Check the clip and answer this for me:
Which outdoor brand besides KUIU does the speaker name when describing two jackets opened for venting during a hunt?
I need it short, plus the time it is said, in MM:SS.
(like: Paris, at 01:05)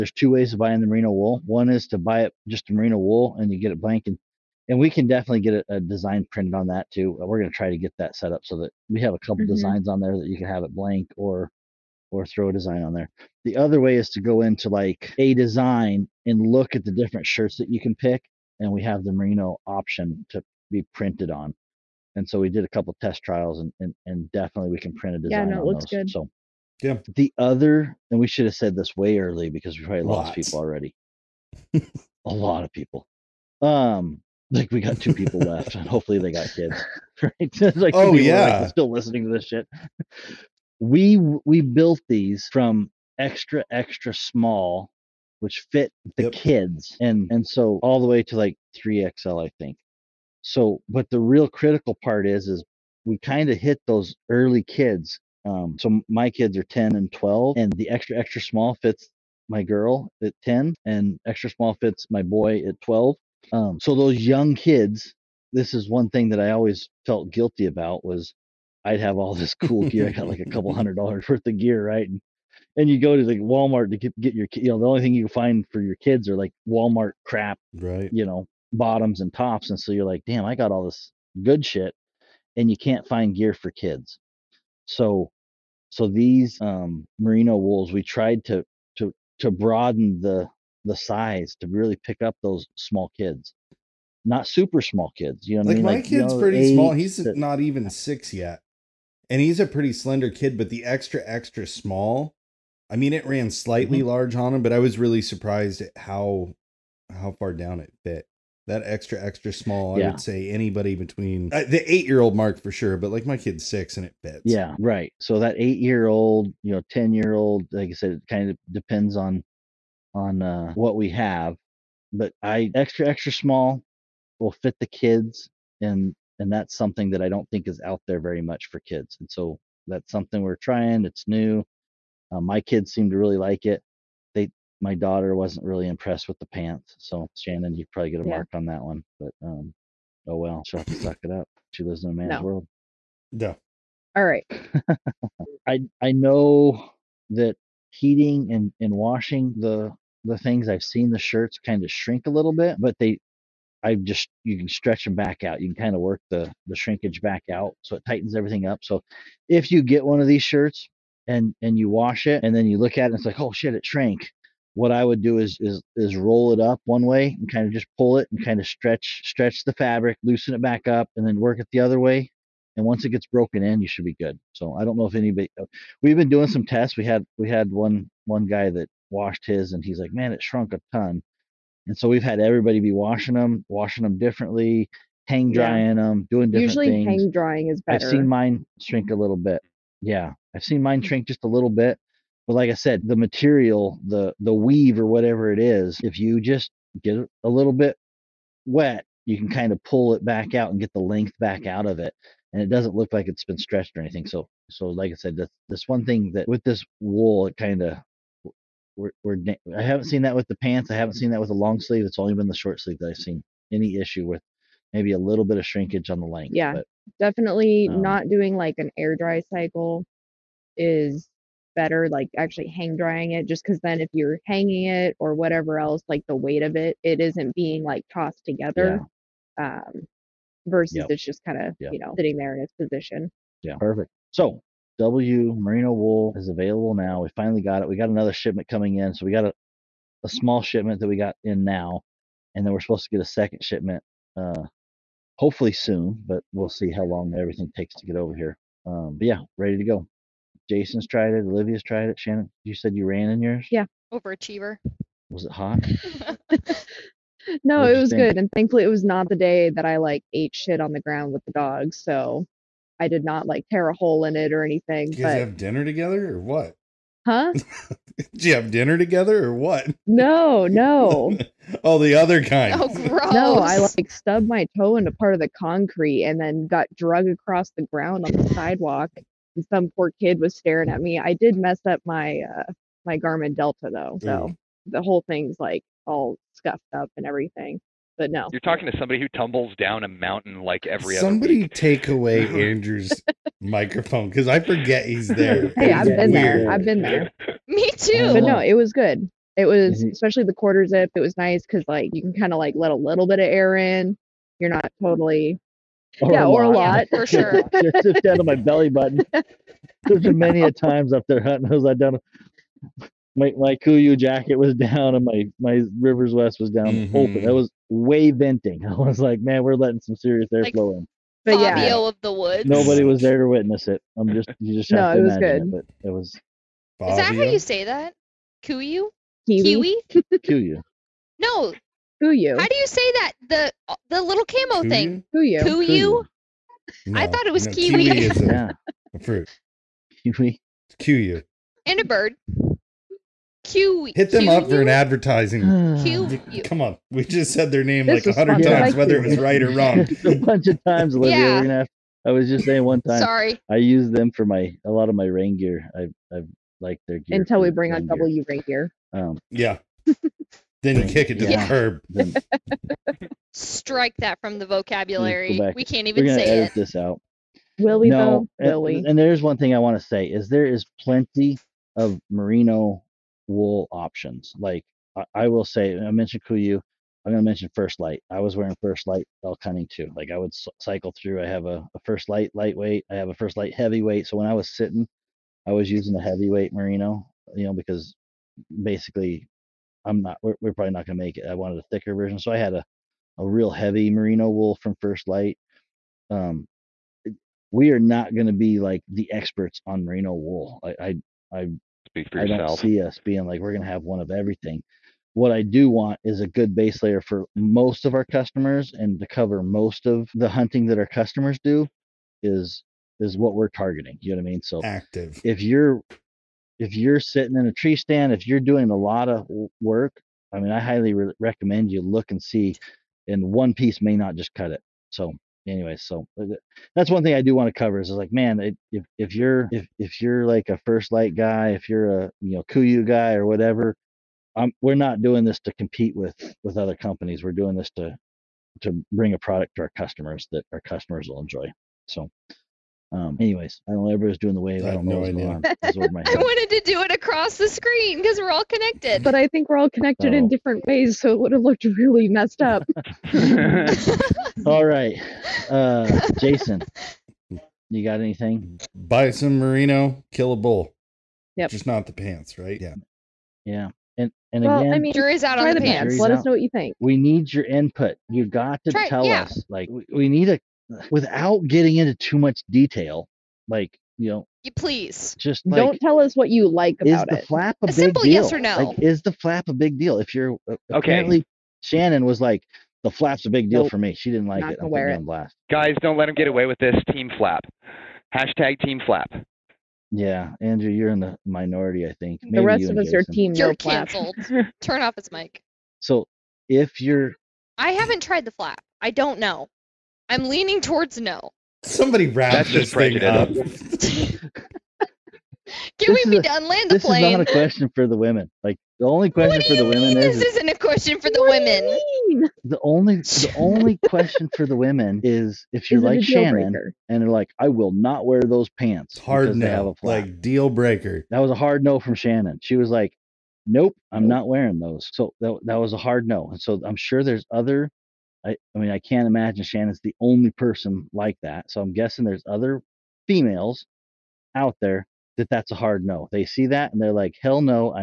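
Rivers West, at 05:15.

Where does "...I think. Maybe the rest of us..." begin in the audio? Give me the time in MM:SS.
08:12.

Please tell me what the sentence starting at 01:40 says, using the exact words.
But the extra extra small, I mean, it ran slightly mm-hmm.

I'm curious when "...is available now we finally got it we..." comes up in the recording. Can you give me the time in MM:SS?
03:56.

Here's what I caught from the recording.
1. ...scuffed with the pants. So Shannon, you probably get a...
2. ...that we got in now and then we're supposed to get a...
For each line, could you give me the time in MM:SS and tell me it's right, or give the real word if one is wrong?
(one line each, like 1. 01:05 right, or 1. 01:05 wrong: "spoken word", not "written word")
1. 02:15 wrong: "impressed", not "scuffed"
2. 04:00 right.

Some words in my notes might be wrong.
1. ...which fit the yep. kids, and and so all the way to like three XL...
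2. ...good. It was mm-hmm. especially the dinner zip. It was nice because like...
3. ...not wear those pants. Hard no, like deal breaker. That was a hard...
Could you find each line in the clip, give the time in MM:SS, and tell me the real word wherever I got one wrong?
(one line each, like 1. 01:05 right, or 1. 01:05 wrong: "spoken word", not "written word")
1. 00:45 right
2. 04:58 wrong: "quarter", not "dinner"
3. 08:37 right.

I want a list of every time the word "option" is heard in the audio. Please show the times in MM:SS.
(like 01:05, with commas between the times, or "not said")
00:19, 06:13.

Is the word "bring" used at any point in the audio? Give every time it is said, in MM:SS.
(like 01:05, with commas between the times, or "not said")
05:57, 07:19.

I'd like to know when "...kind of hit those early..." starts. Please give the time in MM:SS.
00:53.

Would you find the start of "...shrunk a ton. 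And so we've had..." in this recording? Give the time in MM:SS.
03:00.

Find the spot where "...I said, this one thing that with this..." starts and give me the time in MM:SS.
03:25.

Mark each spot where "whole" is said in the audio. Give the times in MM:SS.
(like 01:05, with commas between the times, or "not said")
04:45.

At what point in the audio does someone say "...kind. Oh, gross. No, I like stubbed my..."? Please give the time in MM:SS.
04:32.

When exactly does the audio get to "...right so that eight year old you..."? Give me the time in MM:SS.
01:54.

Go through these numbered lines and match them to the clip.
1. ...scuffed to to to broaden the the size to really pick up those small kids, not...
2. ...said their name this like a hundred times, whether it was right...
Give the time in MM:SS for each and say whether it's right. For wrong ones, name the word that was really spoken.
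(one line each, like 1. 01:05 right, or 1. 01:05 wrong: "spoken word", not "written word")
1. 01:28 wrong: "tried", not "scuffed"
2. 05:47 right.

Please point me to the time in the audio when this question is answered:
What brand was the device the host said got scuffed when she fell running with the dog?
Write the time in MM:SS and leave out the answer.
04:43.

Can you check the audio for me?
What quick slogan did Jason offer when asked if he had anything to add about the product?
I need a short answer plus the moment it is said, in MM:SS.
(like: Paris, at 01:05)
Buy some merino, kill a bull, at 07:38.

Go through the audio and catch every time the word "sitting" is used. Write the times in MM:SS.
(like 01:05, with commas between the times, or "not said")
03:52, 06:24, 06:57.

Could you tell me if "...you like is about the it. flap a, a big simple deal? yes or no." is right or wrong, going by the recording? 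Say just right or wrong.
right.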